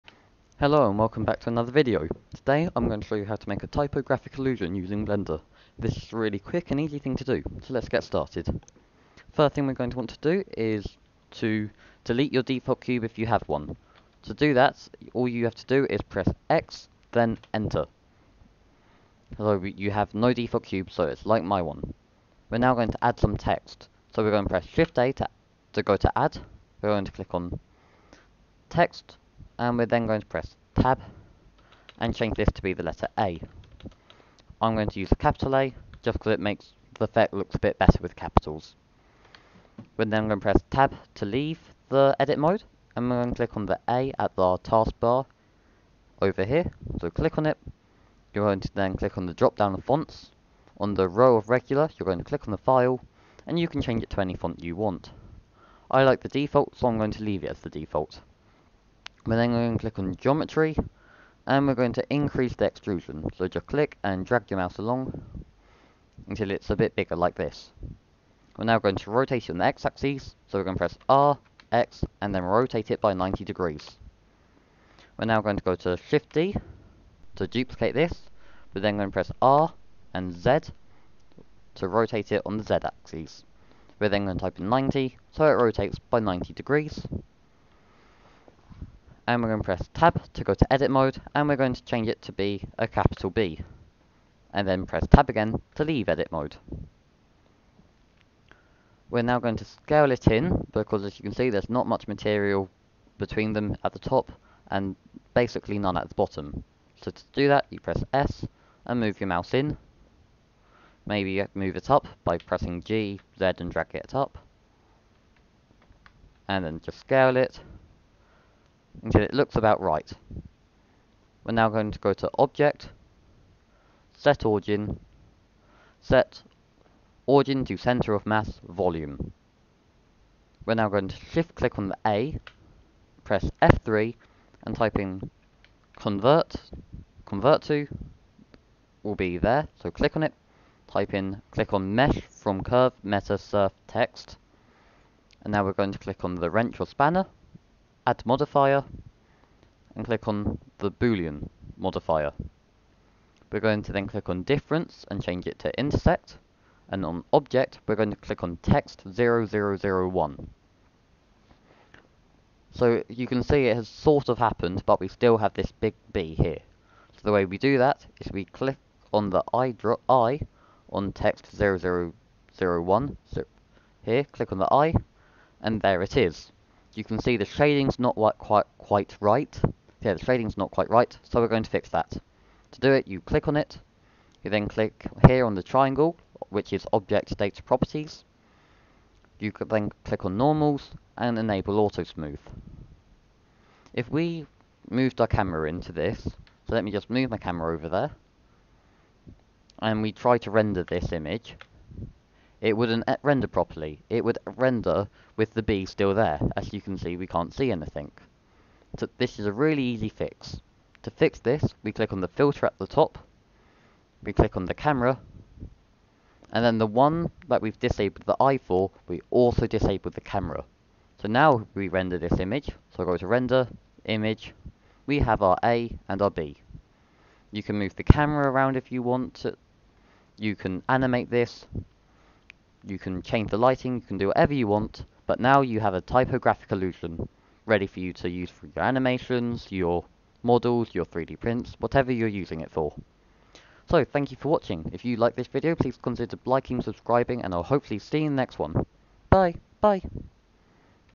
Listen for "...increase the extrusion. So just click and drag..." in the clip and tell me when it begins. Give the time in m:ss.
1:02.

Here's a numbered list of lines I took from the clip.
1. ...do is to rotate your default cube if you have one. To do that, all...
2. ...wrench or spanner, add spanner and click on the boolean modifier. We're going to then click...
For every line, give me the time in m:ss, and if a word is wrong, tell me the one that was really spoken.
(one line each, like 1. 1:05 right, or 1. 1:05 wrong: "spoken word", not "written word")
1. 0:10 wrong: "delete", not "rotate"
2. 2:26 wrong: "modifier", not "spanner".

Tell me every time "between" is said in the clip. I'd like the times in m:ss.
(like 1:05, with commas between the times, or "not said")
1:43.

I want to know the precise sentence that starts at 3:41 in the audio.
So now we render this image, so I go to render, image, we have our A and our B.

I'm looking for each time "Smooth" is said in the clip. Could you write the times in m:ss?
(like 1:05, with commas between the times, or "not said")
3:12.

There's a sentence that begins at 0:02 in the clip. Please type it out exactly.
Today I'm going to show you how to make a typographic illusion using Blender.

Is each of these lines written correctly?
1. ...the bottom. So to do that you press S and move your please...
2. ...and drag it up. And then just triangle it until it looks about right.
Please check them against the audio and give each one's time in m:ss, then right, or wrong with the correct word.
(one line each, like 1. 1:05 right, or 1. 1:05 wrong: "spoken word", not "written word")
1. 1:46 wrong: "mouse", not "please"
2. 1:53 wrong: "scale", not "triangle".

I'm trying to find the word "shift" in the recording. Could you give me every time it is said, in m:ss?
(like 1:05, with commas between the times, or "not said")
0:24, 1:15, 2:11.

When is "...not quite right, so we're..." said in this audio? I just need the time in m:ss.
3:00.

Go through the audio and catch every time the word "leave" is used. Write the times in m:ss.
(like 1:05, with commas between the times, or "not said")
0:41, 0:57, 1:35.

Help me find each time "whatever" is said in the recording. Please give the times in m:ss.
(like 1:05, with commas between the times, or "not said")
3:54, 4:01.